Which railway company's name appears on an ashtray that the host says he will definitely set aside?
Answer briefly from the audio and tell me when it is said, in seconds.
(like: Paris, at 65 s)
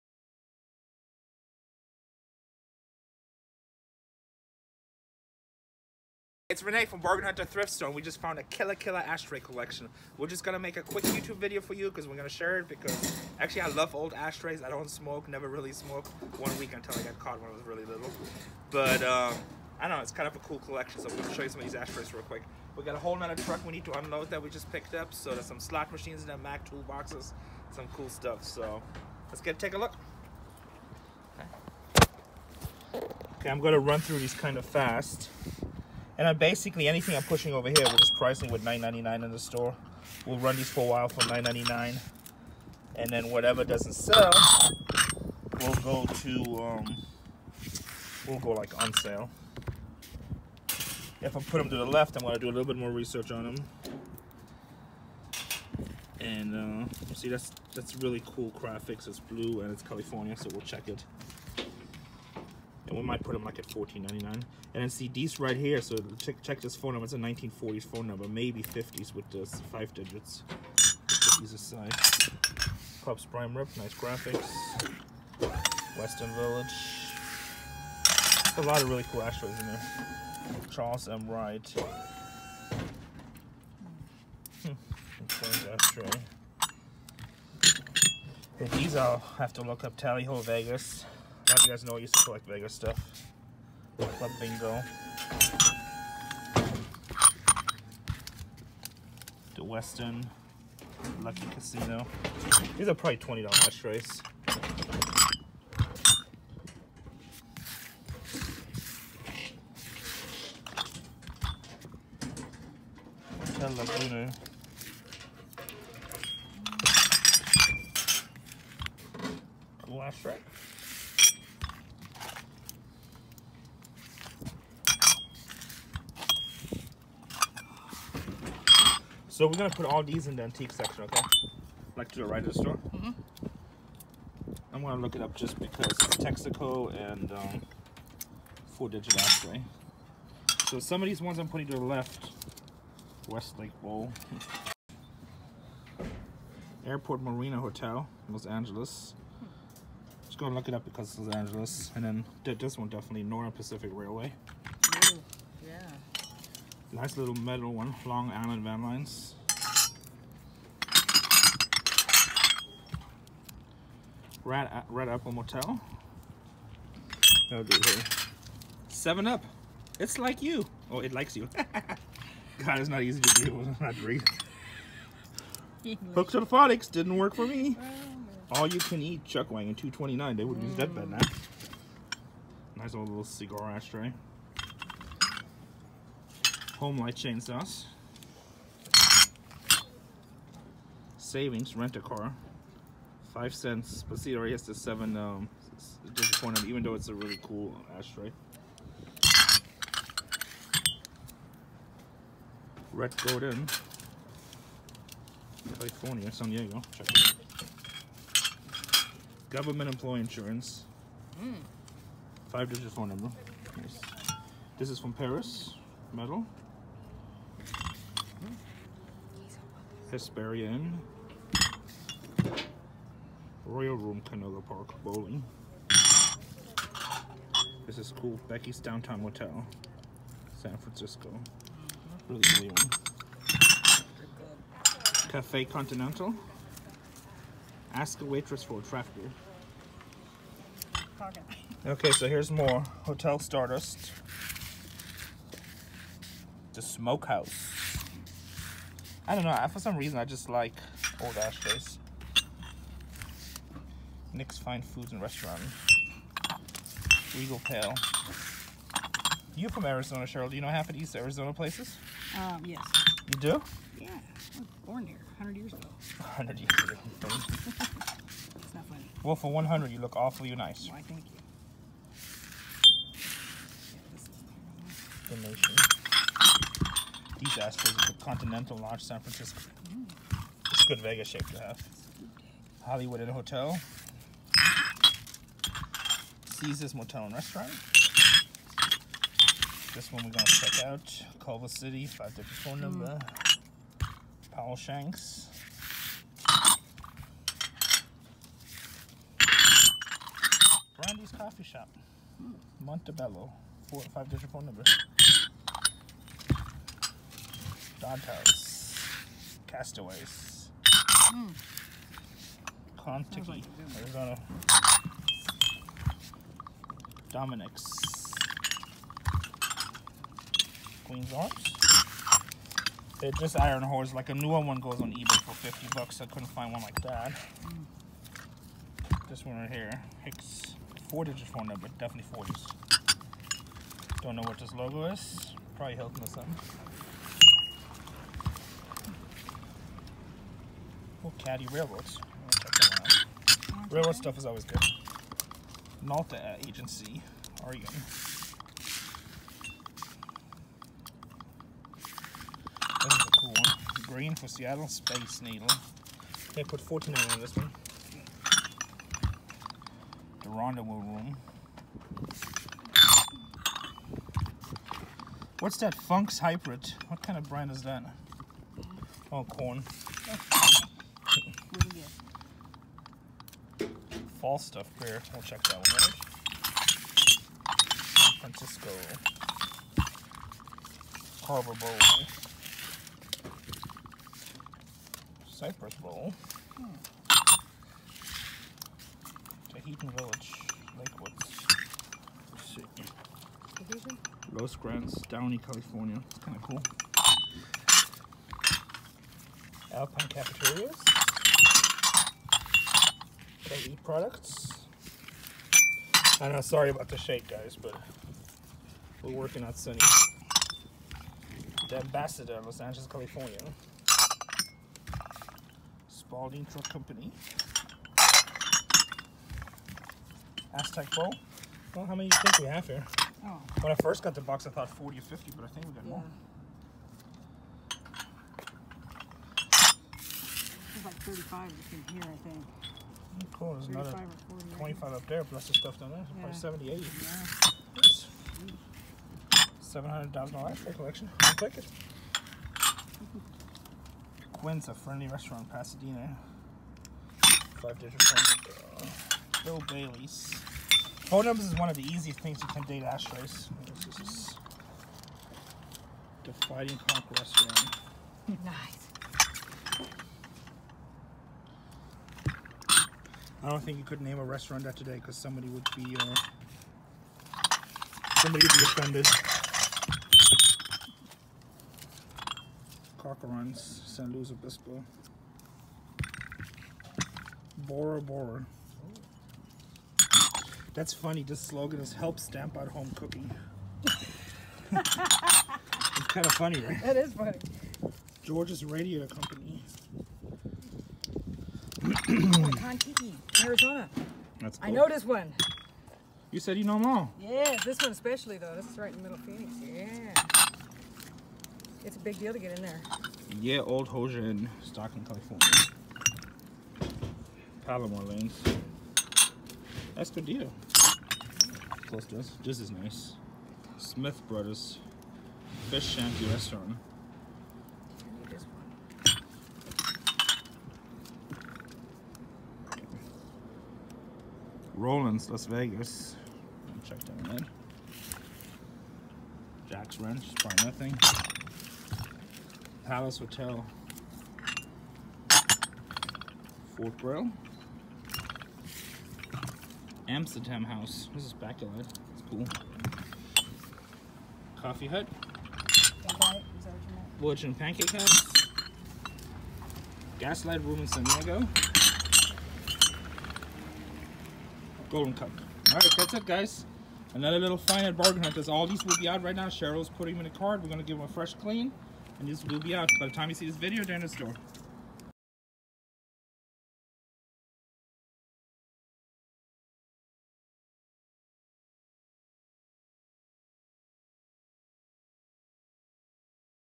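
Northern Pacific Railway, at 153 s.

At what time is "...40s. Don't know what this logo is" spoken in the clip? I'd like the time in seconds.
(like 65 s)
332 s.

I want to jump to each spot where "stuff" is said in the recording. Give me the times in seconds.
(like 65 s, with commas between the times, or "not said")
28 s, 92 s, 344 s, 374 s, 435 s.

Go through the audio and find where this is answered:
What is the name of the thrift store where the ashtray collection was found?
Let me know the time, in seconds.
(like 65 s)
6 s.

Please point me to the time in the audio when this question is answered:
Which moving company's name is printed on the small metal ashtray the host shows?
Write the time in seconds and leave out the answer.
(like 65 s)
158 s.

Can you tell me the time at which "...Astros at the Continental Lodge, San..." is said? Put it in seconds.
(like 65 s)
277 s.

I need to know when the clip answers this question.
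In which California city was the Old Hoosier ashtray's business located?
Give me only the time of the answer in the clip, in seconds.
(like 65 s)
504 s.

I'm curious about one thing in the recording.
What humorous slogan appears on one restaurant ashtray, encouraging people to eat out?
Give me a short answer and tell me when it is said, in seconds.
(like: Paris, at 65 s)
Help stamp out home cooking, at 482 s.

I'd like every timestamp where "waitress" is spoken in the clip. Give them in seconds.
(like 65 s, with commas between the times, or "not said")
238 s.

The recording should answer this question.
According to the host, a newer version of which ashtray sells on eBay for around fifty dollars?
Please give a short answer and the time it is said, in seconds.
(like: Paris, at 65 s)
Iron Horse, at 323 s.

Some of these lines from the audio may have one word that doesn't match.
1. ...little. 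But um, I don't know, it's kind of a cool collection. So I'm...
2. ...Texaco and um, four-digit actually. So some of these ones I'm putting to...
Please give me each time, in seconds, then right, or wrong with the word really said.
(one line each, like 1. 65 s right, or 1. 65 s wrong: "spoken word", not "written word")
1. 17 s right
2. 136 s right.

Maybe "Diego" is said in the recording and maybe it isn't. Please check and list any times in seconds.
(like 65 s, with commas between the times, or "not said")
206 s, 551 s.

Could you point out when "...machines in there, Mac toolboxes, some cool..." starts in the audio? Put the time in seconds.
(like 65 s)
25 s.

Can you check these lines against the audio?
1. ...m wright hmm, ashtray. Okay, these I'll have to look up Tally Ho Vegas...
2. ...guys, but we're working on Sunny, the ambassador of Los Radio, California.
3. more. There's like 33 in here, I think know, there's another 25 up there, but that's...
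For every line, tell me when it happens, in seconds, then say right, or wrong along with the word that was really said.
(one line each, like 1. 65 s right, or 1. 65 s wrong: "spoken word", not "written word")
1. 81 s right
2. 407 s wrong: "Angeles", not "Radio"
3. 426 s wrong: "35", not "33".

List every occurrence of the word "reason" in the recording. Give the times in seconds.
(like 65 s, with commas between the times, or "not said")
249 s.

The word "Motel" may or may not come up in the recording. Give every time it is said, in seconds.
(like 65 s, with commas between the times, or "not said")
165 s, 229 s, 286 s.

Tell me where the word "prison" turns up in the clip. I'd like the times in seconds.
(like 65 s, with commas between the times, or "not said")
not said.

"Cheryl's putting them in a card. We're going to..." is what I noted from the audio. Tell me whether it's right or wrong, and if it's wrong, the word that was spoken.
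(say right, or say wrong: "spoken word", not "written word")
right.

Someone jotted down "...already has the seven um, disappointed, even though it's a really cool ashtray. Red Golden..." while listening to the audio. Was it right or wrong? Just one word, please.
right.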